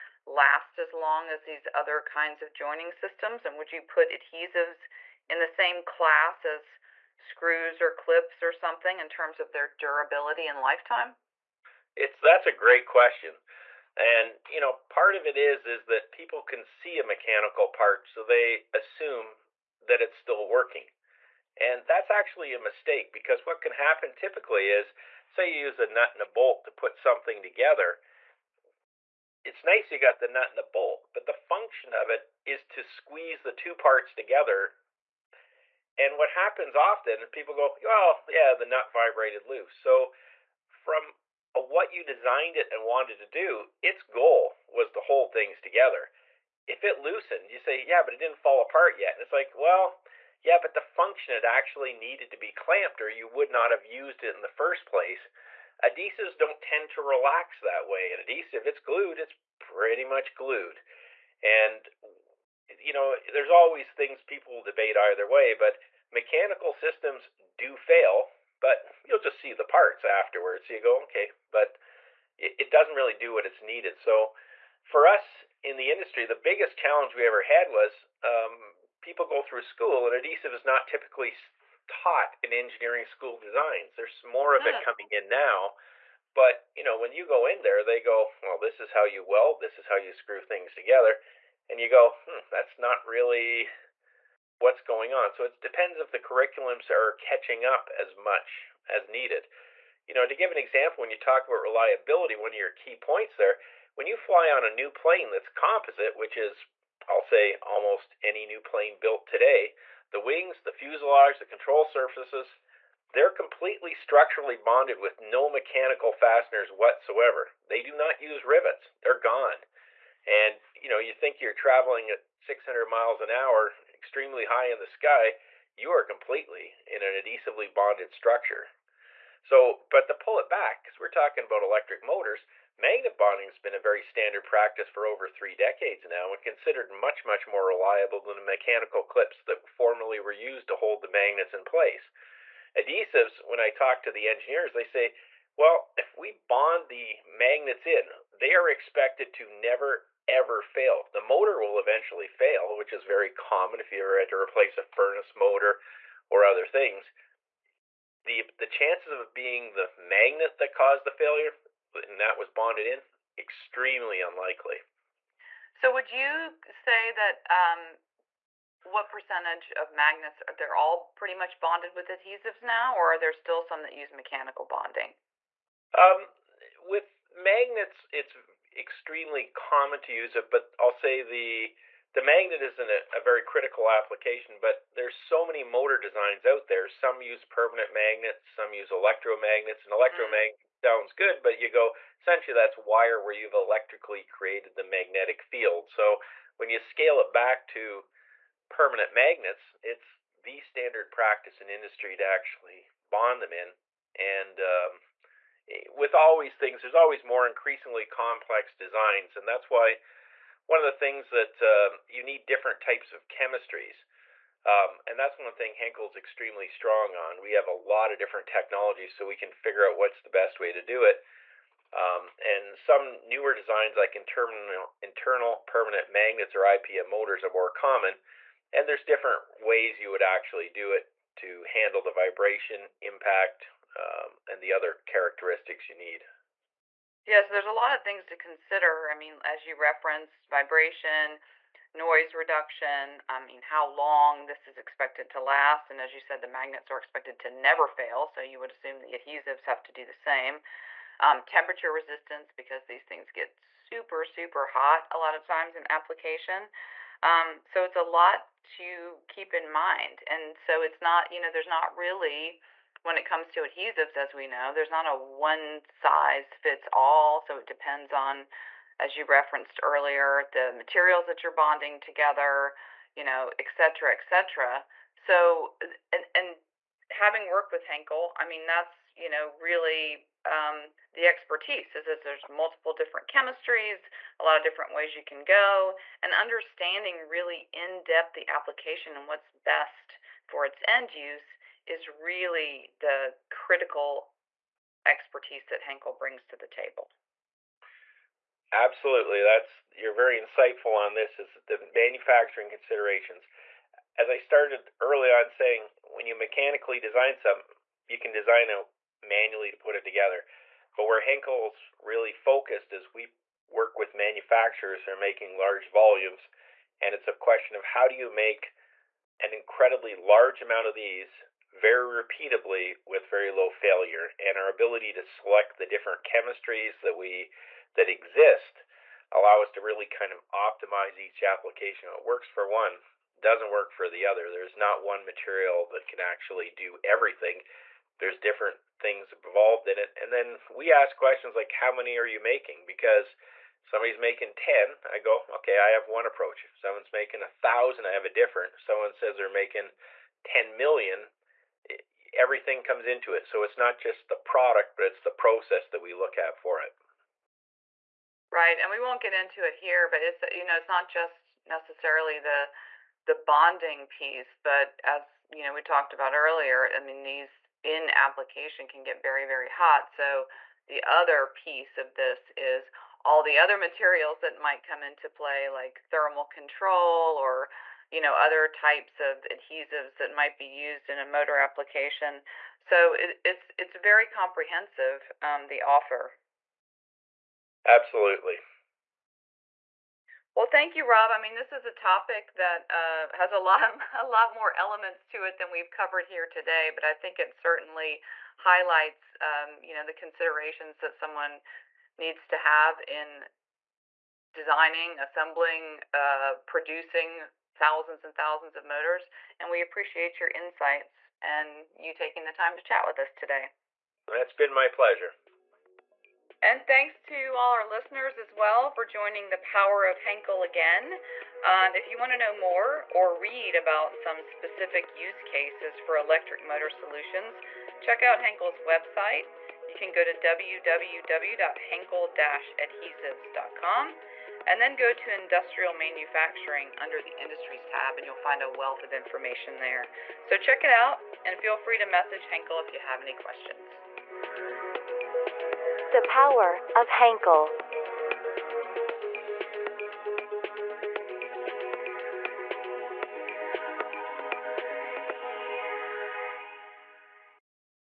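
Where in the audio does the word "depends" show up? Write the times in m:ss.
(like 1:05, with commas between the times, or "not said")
1:35, 4:27.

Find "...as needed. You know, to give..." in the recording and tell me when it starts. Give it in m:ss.
1:38.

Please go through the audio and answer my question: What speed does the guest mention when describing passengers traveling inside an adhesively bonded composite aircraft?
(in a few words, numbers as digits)
600 miles an hour.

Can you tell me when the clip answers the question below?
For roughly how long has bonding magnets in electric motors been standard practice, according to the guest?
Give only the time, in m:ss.
2:15.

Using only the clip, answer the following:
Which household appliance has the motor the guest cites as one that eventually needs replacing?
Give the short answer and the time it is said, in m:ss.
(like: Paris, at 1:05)
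Furnace motor, at 2:34.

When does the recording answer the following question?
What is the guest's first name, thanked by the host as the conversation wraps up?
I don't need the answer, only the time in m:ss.
6:31.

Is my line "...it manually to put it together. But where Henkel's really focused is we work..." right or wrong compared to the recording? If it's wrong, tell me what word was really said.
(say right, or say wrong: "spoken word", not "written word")
right.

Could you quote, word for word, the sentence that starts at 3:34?
Um, and that's one thing Henkel's extremely strong on.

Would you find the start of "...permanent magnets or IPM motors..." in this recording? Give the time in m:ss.
3:45.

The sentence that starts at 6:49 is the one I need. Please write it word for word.
And we appreciate your insights and you taking the time to chat with us today.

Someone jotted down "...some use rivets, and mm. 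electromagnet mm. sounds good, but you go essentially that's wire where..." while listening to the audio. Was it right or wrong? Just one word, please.
wrong.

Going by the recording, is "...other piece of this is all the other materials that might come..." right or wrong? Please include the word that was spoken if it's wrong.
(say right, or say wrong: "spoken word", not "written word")
right.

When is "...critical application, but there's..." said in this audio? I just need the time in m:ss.
3:03.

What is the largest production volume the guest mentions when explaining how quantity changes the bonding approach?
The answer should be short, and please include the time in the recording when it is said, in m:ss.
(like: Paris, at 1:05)
10 million, at 5:50.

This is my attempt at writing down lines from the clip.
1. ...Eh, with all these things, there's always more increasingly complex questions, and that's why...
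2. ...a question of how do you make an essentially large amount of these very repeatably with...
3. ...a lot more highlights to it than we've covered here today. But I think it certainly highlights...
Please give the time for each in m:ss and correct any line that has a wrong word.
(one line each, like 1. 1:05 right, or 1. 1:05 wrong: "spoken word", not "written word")
1. 3:25 wrong: "designs", not "questions"
2. 5:17 wrong: "incredibly", not "essentially"
3. 6:34 wrong: "elements", not "highlights".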